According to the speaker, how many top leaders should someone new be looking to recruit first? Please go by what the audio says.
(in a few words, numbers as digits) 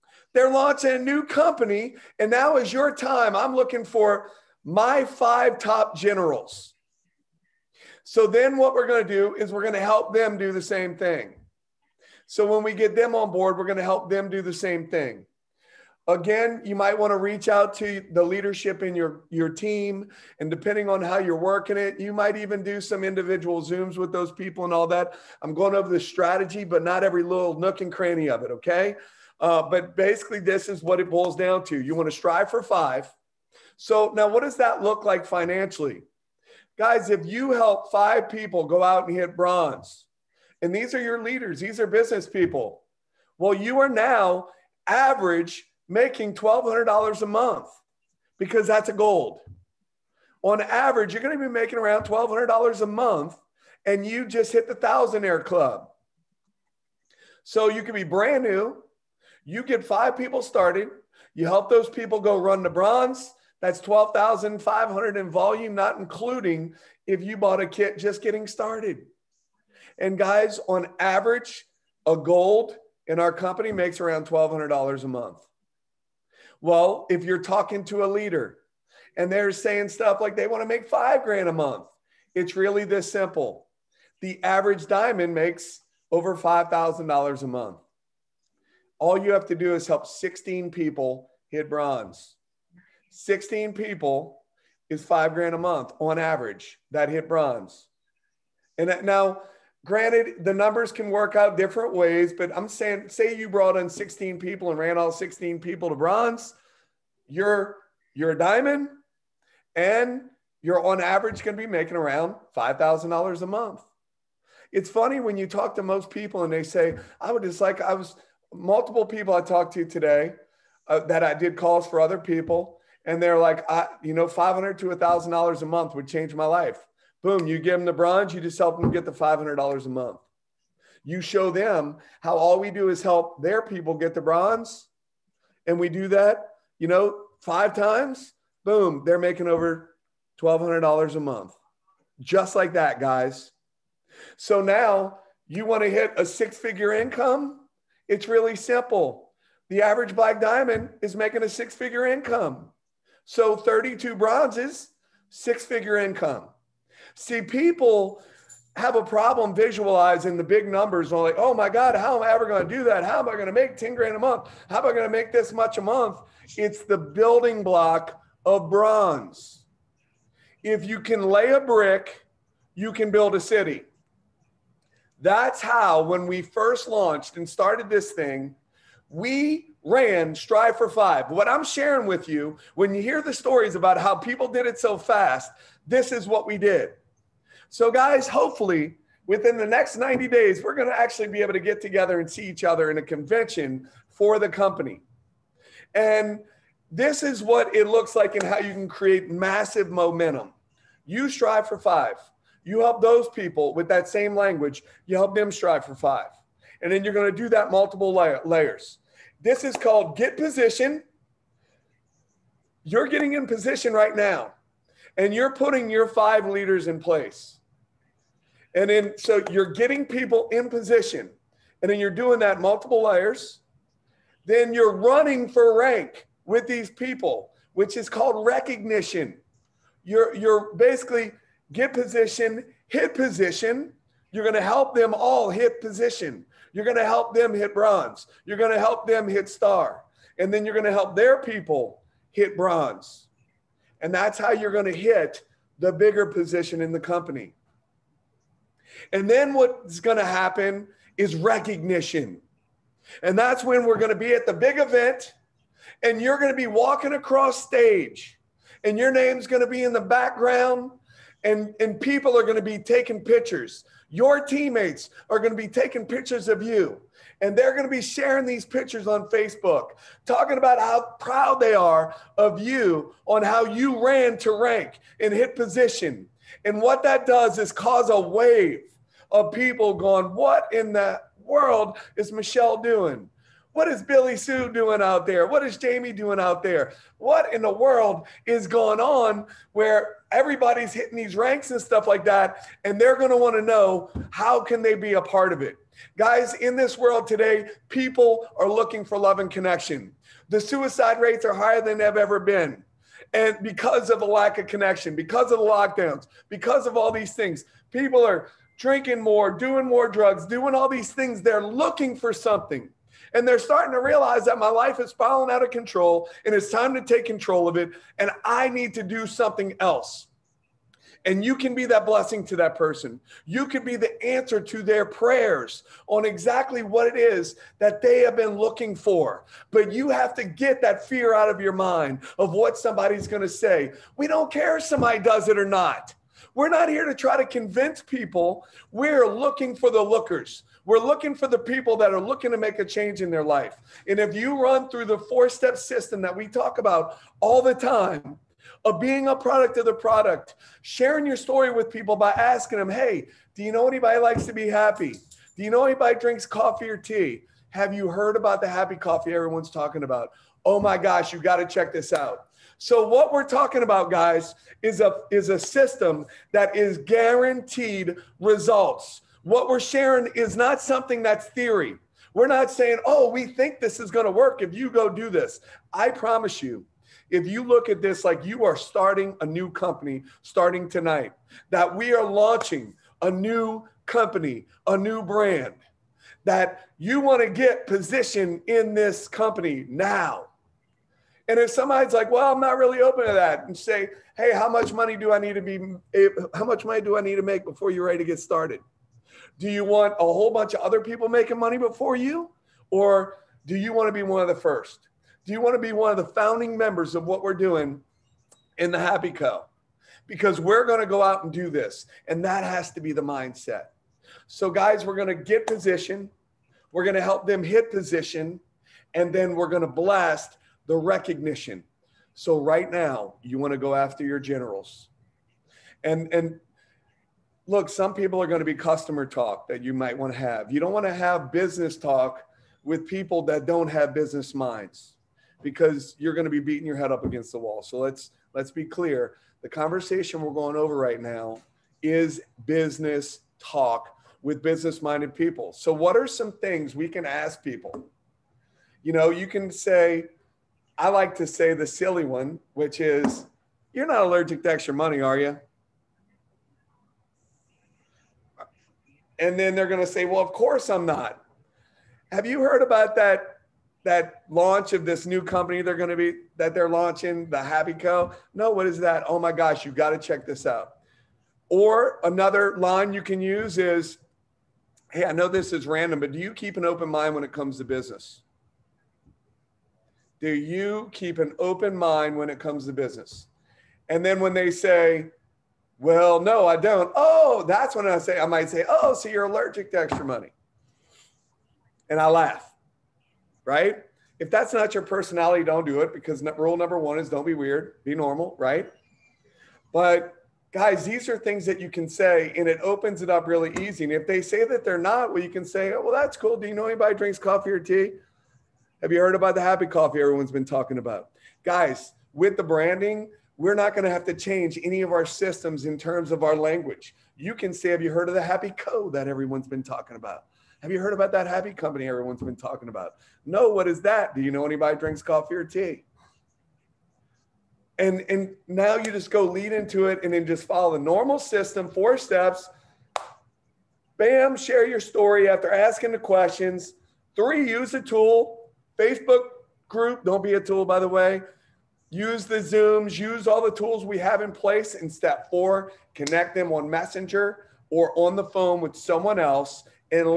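5.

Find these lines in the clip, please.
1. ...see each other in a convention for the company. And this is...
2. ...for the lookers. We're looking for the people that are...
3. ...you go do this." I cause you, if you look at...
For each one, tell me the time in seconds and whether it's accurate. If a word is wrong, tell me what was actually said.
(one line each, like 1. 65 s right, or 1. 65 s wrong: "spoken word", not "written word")
1. 192 s right
2. 339 s right
3. 374 s wrong: "promise", not "cause".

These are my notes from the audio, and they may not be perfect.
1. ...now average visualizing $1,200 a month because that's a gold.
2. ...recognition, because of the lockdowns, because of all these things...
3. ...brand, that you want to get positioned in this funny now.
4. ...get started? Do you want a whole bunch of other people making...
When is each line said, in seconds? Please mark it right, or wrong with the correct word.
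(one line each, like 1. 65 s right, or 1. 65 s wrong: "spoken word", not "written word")
1. 43 s wrong: "making", not "visualizing"
2. 304 s wrong: "connection", not "recognition"
3. 385 s wrong: "company", not "funny"
4. 398 s right.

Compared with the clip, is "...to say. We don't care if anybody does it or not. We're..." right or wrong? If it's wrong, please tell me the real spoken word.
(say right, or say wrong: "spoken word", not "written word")
wrong: "somebody", not "anybody".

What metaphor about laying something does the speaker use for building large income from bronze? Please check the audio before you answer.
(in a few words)
Lay a brick.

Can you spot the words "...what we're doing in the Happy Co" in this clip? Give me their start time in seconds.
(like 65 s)
407 s.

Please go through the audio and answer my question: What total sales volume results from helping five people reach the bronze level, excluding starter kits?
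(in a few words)
12,500.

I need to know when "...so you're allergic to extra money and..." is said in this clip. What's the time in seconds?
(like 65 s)
489 s.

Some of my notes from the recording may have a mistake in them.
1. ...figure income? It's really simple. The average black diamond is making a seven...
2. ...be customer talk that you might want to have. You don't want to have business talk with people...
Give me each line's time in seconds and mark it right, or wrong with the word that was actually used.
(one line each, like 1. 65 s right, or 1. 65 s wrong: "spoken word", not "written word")
1. 146 s wrong: "six", not "seven"
2. 428 s right.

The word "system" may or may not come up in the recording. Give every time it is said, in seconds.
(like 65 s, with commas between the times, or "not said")
345 s, 365 s, 515 s, 531 s.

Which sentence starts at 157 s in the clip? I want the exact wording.
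See, people have a problem visualizing the big numbers.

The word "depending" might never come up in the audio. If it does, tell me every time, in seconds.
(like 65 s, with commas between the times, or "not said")
20 s.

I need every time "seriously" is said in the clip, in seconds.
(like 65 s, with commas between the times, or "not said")
not said.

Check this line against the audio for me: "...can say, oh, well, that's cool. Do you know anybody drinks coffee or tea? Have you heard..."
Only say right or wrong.
right.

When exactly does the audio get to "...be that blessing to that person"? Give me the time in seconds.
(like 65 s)
321 s.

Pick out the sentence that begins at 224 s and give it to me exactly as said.
Then you're running for rank with these people, which is called recognition.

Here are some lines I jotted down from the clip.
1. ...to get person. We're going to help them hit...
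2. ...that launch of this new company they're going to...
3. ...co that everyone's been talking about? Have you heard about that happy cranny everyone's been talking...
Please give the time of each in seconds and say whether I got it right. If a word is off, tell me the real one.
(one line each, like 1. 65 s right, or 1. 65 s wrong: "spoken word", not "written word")
1. 415 s wrong: "position", not "person"
2. 464 s right
3. 518 s wrong: "company", not "cranny".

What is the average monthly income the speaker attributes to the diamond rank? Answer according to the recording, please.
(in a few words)
$5,000.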